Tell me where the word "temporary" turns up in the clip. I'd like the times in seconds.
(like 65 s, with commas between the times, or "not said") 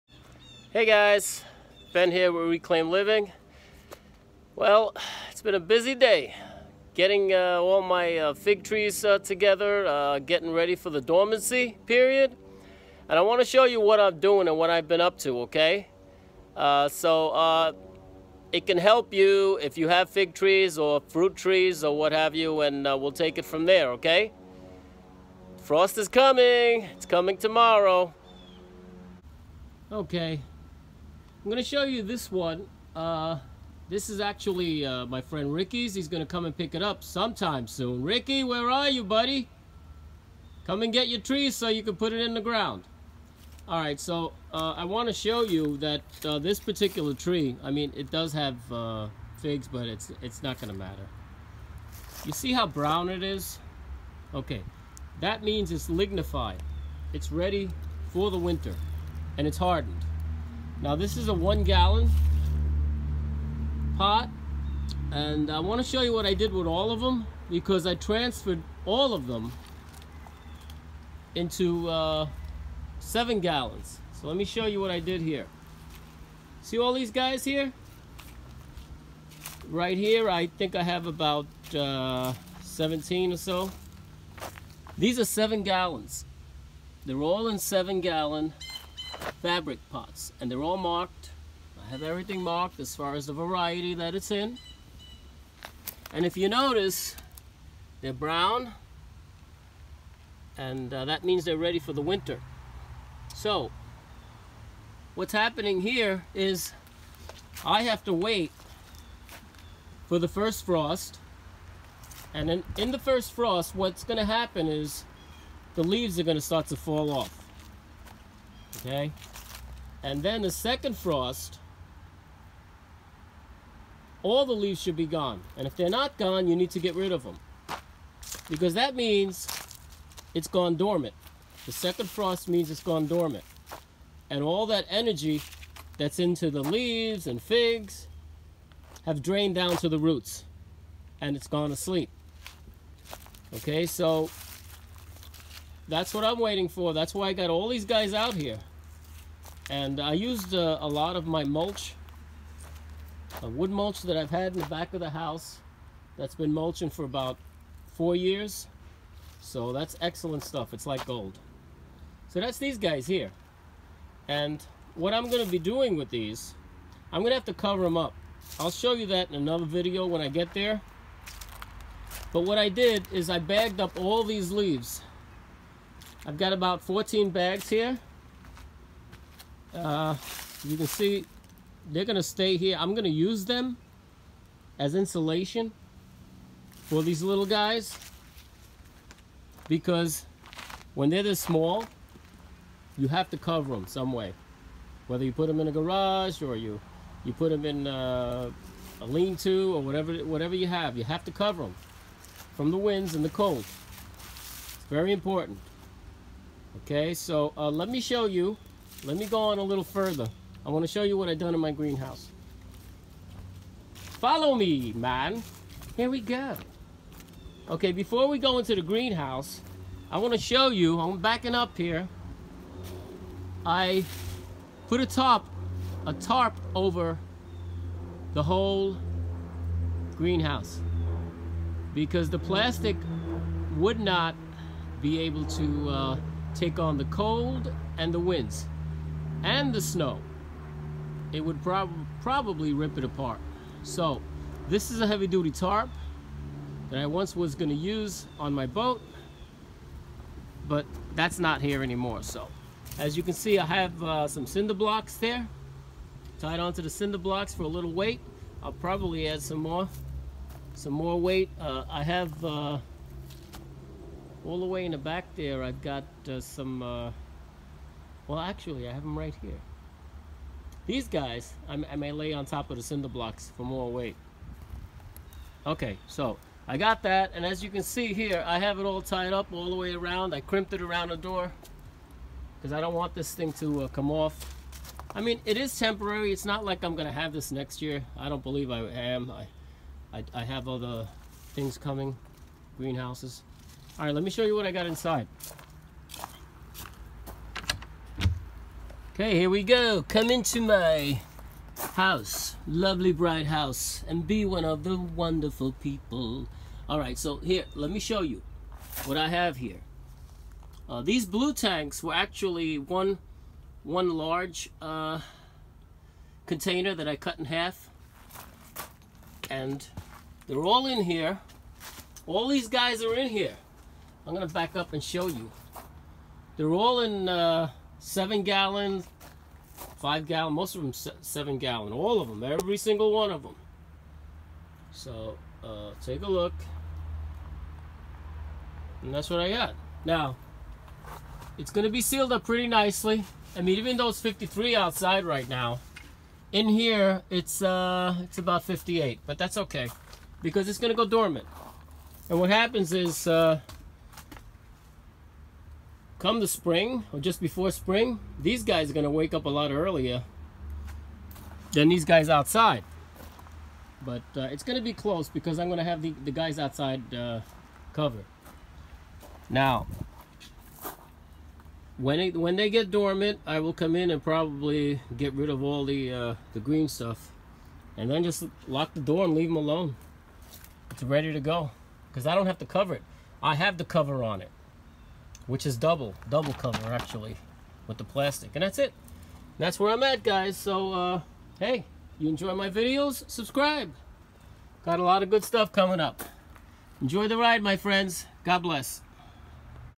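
285 s.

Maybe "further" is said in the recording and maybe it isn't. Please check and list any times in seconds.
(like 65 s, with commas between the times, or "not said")
209 s.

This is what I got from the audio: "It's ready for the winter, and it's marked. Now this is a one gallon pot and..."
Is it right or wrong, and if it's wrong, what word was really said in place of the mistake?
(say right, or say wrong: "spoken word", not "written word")
wrong: "hardened", not "marked".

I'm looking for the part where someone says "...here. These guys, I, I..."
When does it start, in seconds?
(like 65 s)
269 s.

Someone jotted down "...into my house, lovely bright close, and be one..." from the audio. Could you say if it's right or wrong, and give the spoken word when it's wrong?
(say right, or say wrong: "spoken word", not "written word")
wrong: "house", not "close".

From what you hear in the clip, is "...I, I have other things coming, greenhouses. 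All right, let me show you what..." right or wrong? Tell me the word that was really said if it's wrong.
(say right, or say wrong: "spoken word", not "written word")
right.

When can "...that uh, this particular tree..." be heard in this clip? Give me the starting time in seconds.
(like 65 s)
45 s.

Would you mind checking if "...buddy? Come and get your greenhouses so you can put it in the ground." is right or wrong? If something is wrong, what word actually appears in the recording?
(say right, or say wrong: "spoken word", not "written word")
wrong: "trees", not "greenhouses".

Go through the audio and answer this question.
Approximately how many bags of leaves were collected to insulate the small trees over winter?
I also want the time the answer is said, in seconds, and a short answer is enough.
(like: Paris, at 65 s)
14, at 176 s.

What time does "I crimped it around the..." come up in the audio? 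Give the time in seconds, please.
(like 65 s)
280 s.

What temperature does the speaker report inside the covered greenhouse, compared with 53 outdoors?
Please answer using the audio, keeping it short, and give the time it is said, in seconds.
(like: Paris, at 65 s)
58, at 348 s.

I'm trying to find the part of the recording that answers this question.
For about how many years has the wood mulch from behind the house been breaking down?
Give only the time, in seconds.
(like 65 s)
157 s.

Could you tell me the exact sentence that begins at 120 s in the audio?
And then the second frost, all the leaves should be gone.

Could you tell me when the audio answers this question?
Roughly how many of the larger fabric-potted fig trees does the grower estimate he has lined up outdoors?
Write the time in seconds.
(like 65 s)
82 s.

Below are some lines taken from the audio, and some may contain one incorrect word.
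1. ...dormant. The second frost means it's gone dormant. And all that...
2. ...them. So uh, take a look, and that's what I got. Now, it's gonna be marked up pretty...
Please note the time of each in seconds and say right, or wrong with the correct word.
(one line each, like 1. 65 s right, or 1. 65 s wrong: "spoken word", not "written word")
1. 130 s right
2. 333 s wrong: "sealed", not "marked".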